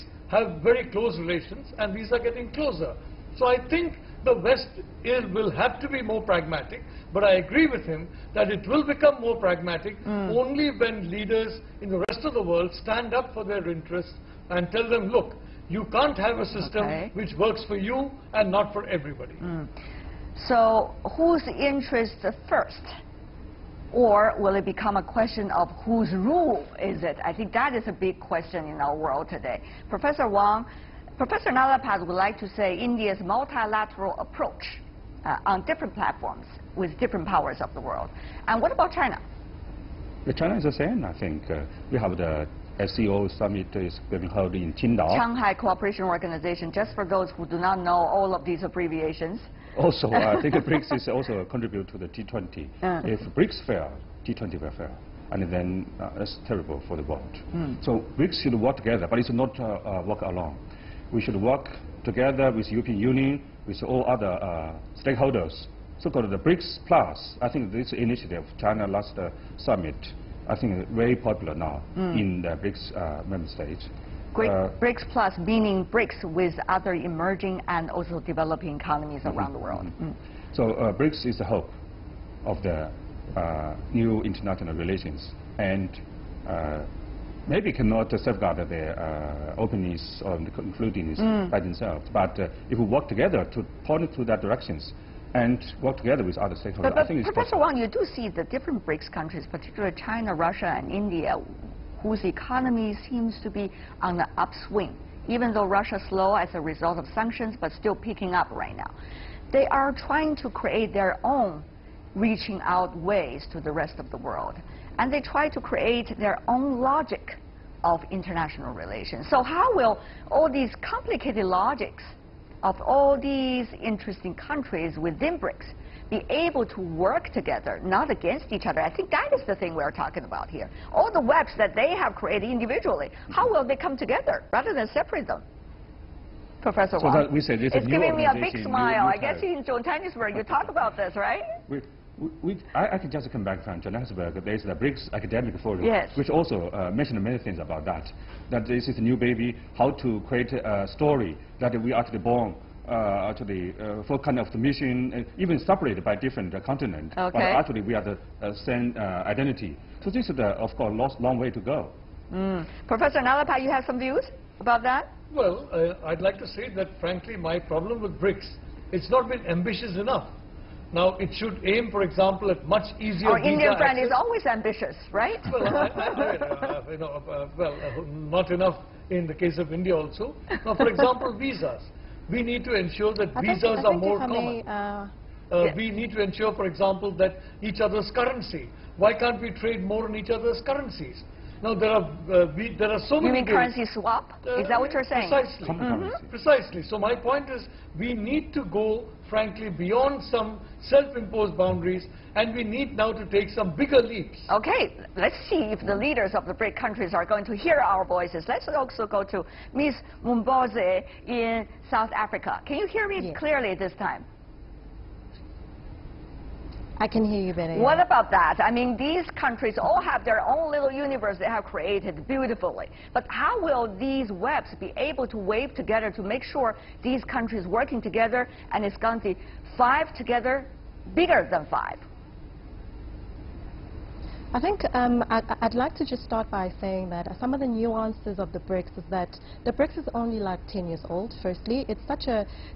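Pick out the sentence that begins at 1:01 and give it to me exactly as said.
We should work together with European Union, with all other uh, stakeholders.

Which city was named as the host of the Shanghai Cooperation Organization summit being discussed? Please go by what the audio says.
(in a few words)
Qingdao.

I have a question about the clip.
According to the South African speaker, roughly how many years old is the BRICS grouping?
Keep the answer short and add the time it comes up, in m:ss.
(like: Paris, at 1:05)
10 years, at 4:00.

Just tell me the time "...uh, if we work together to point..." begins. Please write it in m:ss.
1:32.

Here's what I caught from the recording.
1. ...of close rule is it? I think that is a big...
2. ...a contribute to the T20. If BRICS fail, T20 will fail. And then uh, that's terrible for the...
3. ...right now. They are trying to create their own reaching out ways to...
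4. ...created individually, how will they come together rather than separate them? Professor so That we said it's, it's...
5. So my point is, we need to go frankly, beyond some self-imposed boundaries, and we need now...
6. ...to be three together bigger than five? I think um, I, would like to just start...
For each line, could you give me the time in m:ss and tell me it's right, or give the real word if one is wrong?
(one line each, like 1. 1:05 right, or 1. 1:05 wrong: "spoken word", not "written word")
1. 0:25 wrong: "whose", not "close"
2. 0:51 right
3. 1:48 right
4. 2:12 right
5. 3:16 right
6. 3:49 wrong: "five", not "three".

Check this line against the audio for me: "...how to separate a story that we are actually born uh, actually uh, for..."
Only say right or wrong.
wrong.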